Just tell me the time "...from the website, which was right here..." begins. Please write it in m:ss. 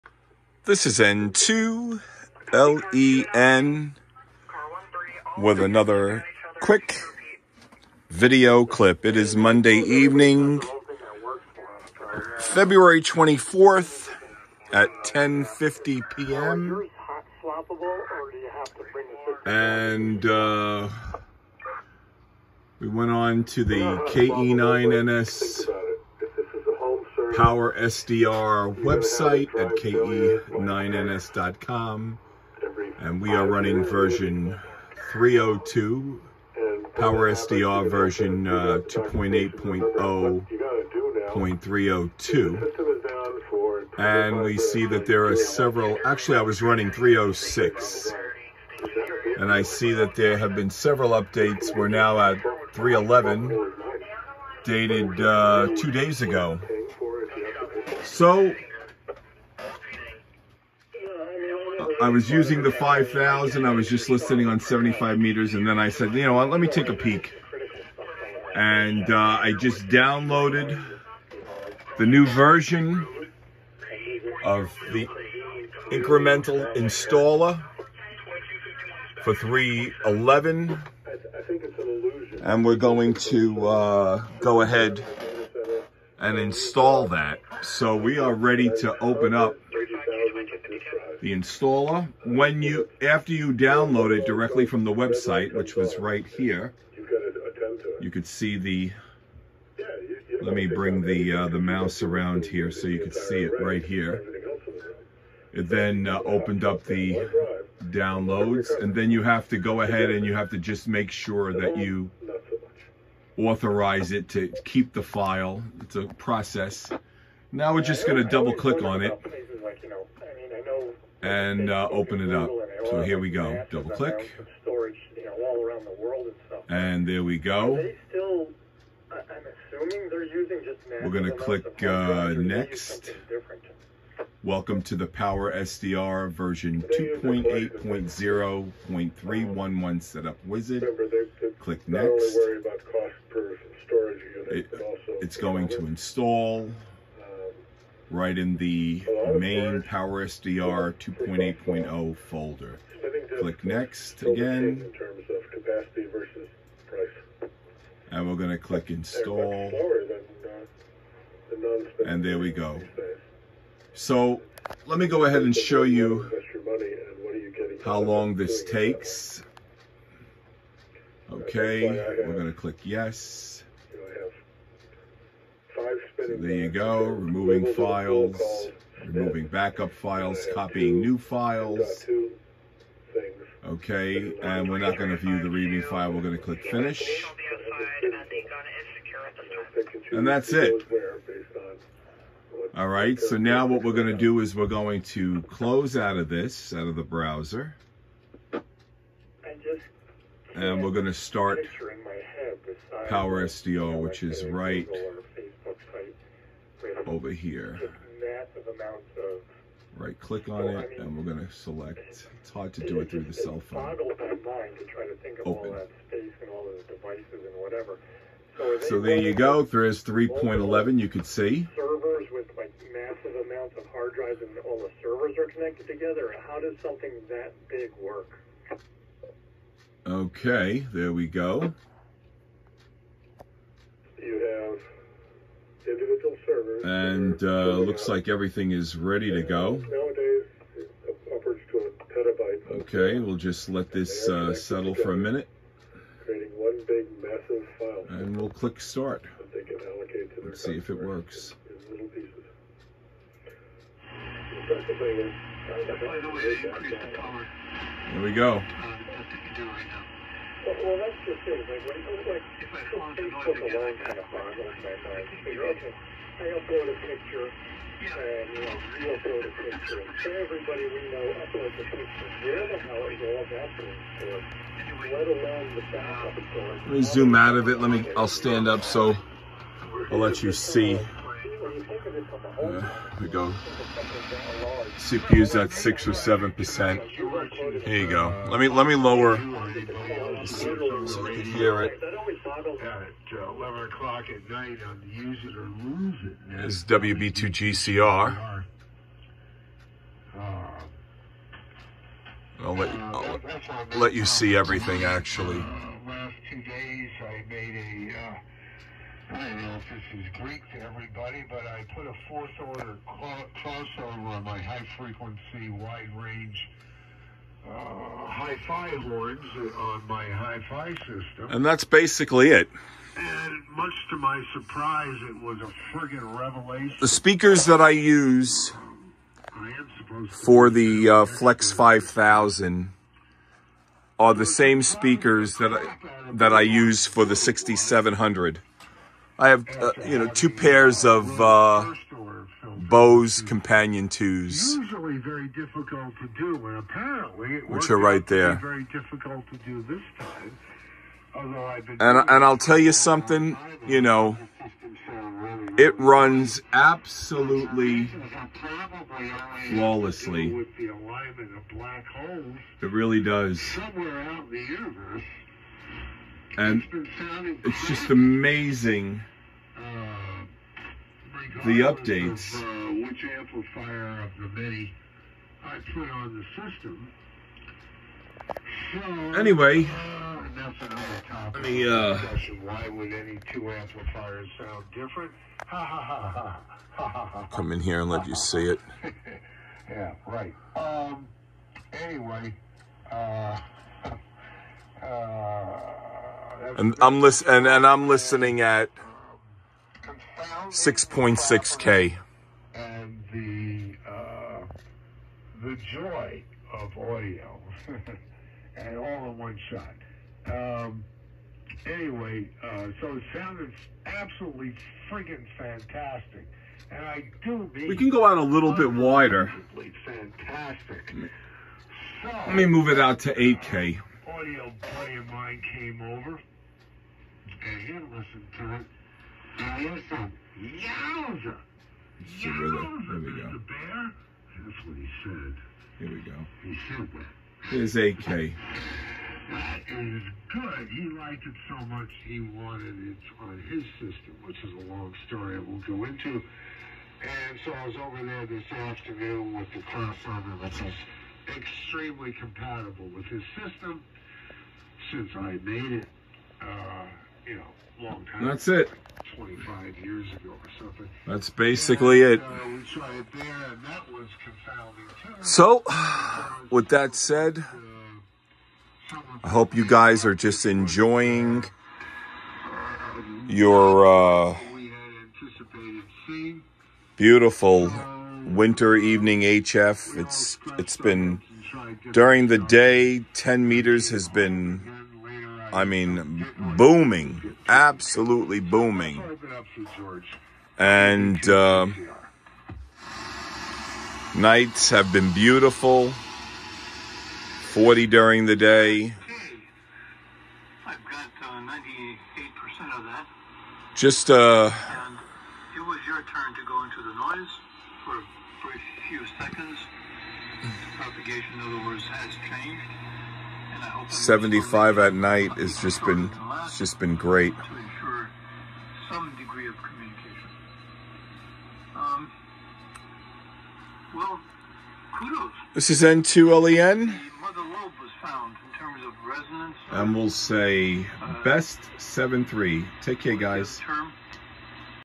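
1:34.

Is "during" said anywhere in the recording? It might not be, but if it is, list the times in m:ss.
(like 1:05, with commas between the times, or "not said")
8:02, 8:18.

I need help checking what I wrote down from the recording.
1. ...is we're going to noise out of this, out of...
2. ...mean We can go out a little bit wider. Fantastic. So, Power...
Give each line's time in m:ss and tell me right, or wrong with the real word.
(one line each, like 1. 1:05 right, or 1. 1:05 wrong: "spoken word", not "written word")
1. 3:14 wrong: "close", not "noise"
2. 6:57 wrong: "Let", not "Power".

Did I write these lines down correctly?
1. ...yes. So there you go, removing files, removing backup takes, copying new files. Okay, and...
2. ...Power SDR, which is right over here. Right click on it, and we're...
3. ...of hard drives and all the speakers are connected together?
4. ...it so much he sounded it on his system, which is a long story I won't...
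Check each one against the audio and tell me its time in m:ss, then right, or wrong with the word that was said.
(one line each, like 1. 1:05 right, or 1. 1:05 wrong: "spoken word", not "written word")
1. 2:52 wrong: "files", not "takes"
2. 3:23 right
3. 3:43 wrong: "servers", not "speakers"
4. 7:21 wrong: "wanted", not "sounded".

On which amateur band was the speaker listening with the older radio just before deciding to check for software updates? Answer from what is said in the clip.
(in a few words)
75 meters.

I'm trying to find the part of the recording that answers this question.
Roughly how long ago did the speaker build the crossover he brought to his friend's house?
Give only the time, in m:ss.
7:39.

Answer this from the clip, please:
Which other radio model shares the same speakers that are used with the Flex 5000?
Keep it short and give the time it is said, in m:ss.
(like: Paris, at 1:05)
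6700, at 5:37.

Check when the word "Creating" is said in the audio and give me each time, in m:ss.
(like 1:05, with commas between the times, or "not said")
4:06.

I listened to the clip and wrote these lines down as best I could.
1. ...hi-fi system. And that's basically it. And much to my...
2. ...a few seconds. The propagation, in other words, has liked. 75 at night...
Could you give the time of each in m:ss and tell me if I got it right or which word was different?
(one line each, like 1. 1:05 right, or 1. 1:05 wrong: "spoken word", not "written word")
1. 5:20 right
2. 8:28 wrong: "changed", not "liked".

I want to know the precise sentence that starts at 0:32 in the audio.
And we are running version 302, Power SDR version uh, 2.8.0.302.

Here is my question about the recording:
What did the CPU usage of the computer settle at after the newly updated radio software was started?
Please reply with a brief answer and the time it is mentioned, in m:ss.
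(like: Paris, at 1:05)
6 or 7 percent, at 4:45.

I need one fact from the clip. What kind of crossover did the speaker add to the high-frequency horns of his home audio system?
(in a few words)
fourth order.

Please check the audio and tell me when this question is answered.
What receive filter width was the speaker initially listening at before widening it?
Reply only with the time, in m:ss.
6:40.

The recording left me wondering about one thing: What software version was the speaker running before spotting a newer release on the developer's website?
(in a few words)
306.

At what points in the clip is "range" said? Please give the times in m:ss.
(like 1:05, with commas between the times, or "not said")
5:16.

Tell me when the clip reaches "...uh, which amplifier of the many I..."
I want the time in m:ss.
6:12.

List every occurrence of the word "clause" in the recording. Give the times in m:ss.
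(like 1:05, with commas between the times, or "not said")
not said.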